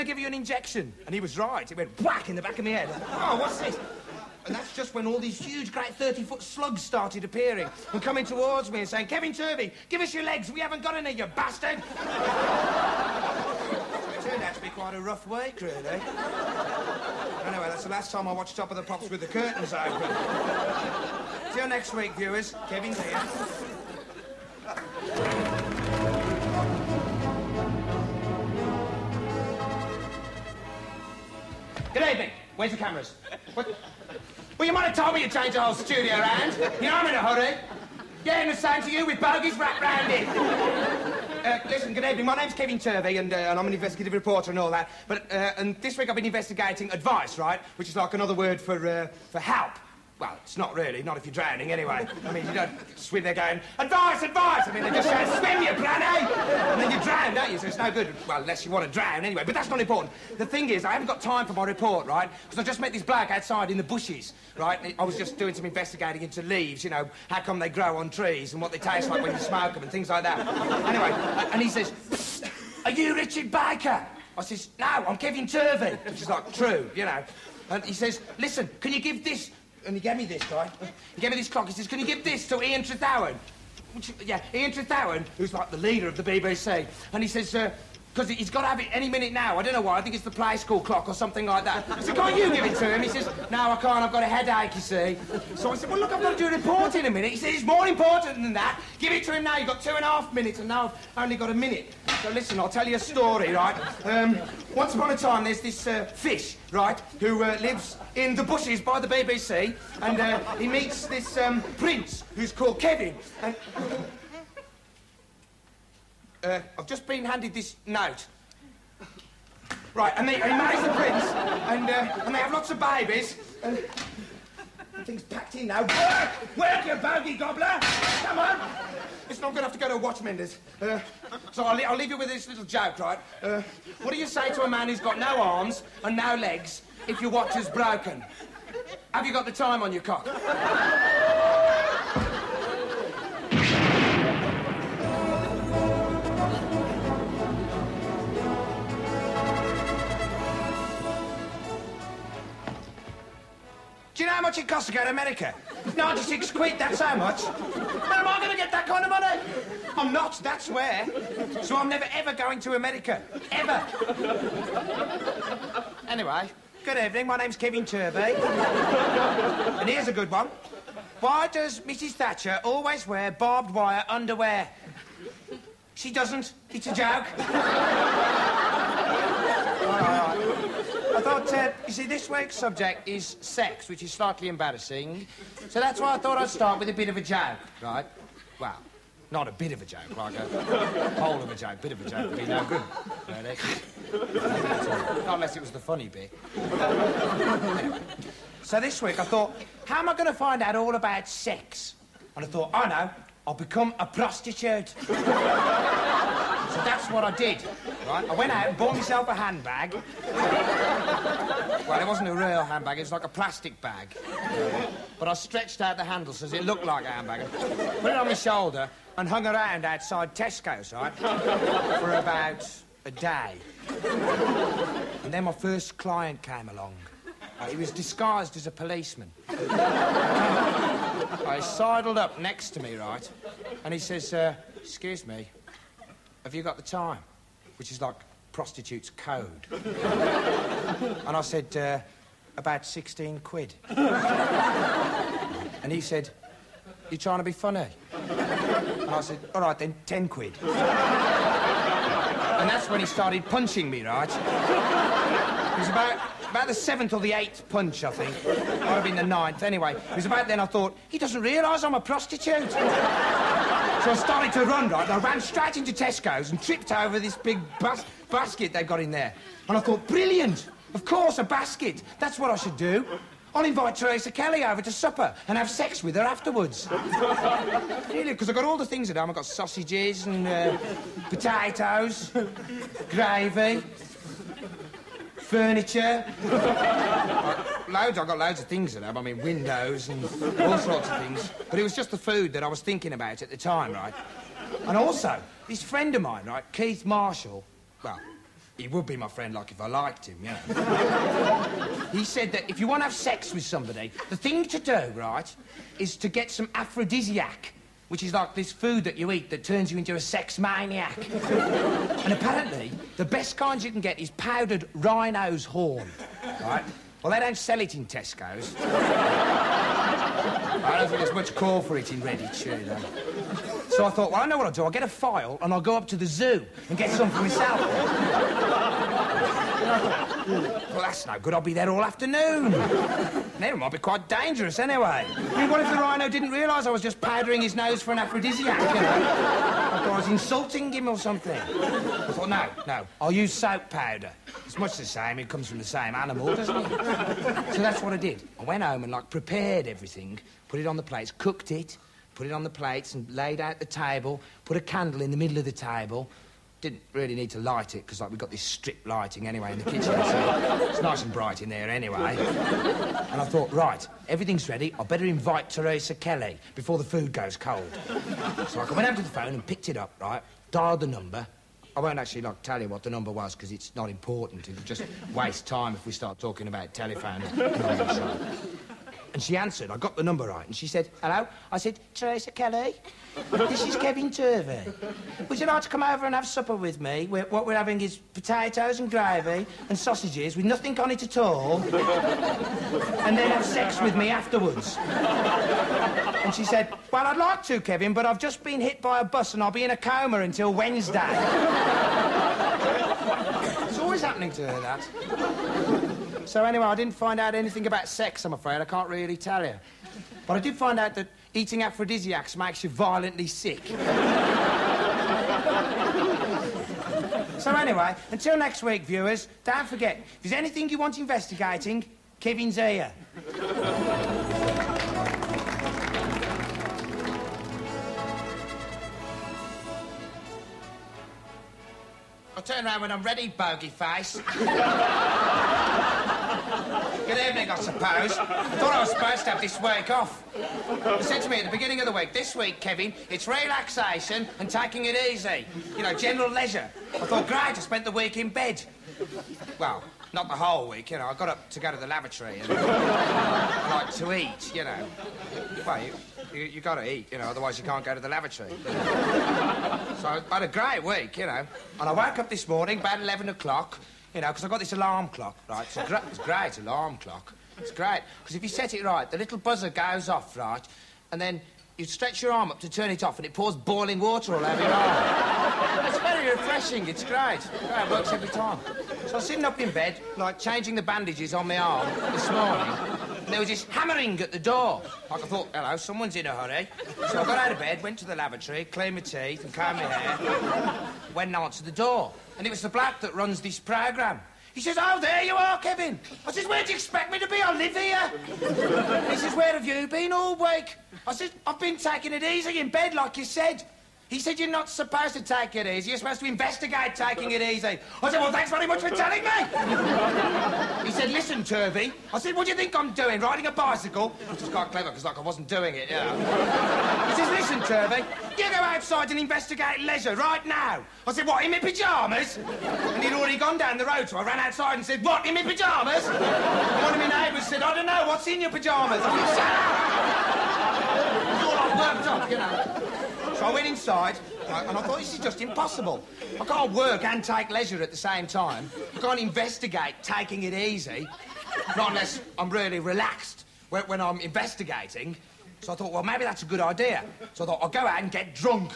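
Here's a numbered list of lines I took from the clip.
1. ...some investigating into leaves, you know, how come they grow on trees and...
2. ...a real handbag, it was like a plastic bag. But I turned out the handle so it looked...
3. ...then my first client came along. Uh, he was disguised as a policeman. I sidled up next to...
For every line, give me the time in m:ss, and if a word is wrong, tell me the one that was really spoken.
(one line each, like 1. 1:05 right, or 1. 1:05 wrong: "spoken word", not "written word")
1. 1:05 right
2. 3:32 wrong: "stretched", not "turned"
3. 3:45 right.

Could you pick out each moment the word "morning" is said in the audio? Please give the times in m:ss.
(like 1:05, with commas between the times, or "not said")
7:42, 8:02.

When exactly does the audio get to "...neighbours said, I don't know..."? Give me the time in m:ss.
8:47.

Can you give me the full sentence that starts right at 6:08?
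So I went up to the phone and picked it up, right, dialed the number.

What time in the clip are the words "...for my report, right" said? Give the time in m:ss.
1:01.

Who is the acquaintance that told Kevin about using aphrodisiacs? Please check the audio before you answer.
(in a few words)
Keith Marshall.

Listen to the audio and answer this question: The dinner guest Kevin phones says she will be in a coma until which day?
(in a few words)
Wednesday.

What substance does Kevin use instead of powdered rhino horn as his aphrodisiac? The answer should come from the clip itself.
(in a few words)
Soap powder.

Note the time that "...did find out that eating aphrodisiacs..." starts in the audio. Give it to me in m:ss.
6:50.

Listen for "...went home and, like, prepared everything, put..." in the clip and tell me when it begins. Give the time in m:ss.
5:48.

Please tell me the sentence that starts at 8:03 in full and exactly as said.
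And there was this hammering at the door.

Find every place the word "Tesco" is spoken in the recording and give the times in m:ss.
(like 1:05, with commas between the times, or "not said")
3:40, 4:25, 5:18.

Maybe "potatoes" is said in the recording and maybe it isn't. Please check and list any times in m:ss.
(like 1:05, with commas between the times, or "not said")
4:41, 6:28.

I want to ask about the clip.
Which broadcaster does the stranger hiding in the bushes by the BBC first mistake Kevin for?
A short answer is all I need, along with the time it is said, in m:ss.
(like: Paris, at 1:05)
Richard Baker, at 1:13.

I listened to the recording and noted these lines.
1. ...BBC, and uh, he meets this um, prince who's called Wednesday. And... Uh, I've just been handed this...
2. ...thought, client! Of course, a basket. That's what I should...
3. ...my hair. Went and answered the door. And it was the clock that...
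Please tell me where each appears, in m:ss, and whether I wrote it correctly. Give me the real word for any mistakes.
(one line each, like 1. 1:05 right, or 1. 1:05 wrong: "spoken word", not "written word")
1. 1:49 wrong: "Kevin", not "Wednesday"
2. 4:29 wrong: "brilliant", not "client"
3. 8:09 wrong: "black", not "clock".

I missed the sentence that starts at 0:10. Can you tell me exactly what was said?
We haven't got any, you bastard.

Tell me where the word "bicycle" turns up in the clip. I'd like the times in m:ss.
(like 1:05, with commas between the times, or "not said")
8:33.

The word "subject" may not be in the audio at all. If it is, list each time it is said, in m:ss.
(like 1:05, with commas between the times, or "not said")
3:02.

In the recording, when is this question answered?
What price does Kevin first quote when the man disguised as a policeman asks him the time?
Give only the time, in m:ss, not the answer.
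4:02.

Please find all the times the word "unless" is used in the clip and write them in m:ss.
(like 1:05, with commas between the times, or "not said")
0:58, 3:15, 9:02.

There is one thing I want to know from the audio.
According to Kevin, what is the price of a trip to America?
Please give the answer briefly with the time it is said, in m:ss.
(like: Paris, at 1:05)
96 quid, at 2:35.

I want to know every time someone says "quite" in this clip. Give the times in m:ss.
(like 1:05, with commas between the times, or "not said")
0:14, 5:33, 8:34.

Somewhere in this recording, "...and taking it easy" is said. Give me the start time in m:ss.
7:24.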